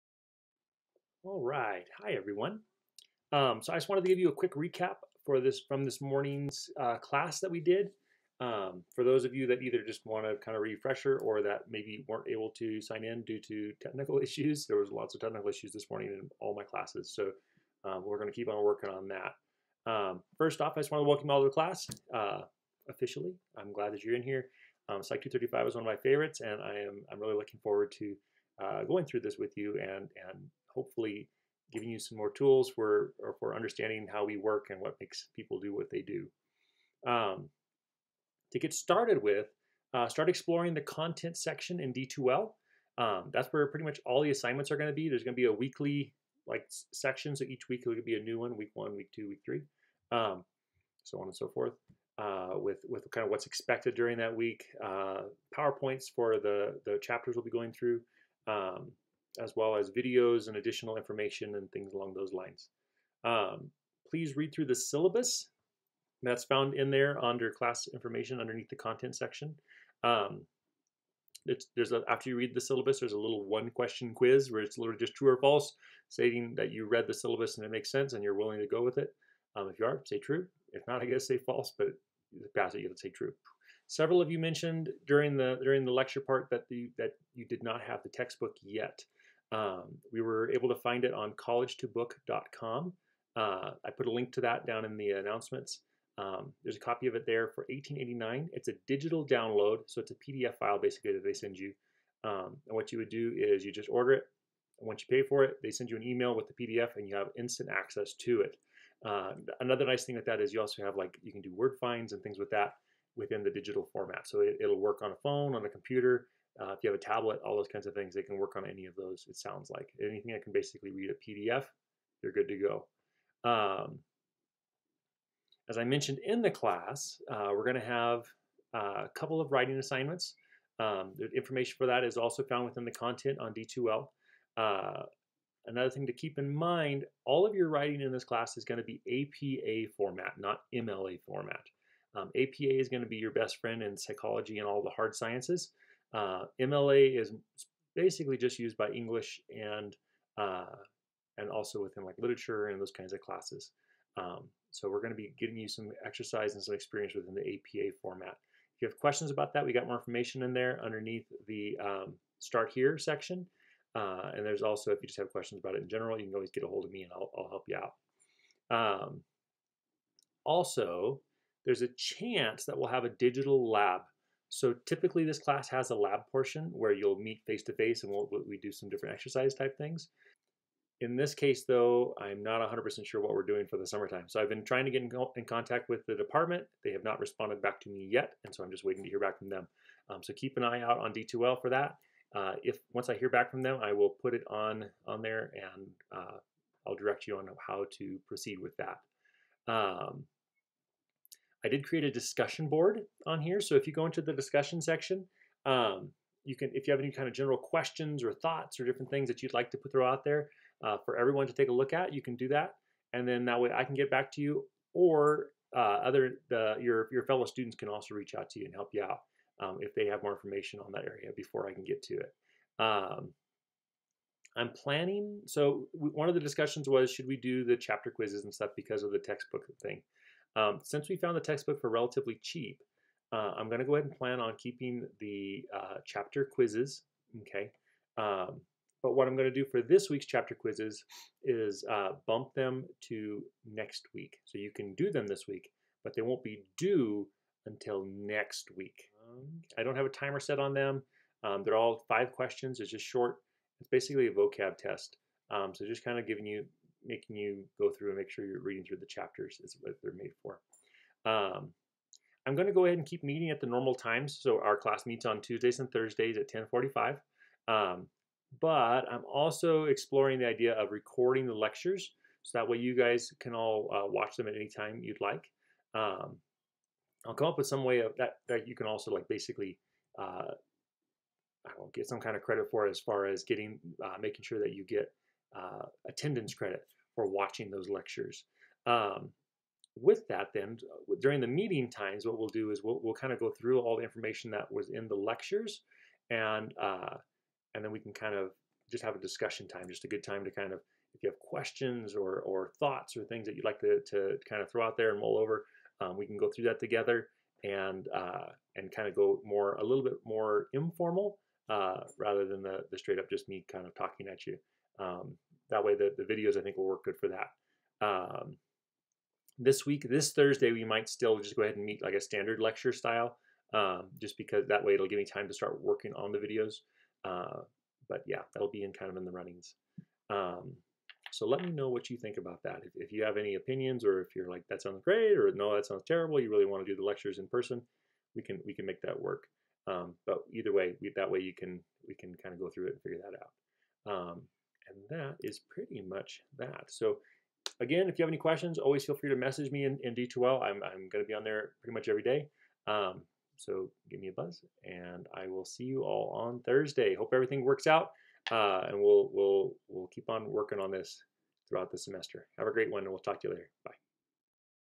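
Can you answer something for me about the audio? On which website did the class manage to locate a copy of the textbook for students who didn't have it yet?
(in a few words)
college2book.com.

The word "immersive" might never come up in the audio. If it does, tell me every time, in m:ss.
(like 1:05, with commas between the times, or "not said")
not said.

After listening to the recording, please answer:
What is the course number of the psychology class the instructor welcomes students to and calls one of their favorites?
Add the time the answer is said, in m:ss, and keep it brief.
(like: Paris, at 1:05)
Psych 235, at 0:25.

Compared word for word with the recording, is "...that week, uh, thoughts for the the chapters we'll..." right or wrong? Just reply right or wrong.
wrong.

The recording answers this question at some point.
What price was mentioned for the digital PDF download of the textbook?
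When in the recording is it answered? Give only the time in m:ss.
1:37.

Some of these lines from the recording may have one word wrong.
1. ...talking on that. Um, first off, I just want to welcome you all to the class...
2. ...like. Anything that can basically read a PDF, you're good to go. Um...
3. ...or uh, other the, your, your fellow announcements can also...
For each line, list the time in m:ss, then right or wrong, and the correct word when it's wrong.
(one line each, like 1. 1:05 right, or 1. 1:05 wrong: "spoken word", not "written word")
1. 0:18 wrong: "working", not "talking"
2. 1:59 right
3. 3:34 wrong: "students", not "announcements".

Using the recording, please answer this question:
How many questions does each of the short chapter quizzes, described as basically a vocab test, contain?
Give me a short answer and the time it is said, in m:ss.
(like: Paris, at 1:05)
5, at 4:12.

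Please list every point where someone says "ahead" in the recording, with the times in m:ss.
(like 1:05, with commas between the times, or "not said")
3:53, 4:22, 5:21.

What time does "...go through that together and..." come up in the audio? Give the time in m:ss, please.
5:06.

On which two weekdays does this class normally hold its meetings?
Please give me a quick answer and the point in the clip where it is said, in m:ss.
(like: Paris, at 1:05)
Tuesdays and Thursdays, at 4:25.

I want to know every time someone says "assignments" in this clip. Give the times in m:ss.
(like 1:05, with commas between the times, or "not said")
0:44, 2:09.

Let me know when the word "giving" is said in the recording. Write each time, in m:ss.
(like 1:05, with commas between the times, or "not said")
0:31, 2:35, 4:16.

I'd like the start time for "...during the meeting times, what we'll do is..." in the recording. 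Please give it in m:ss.
4:51.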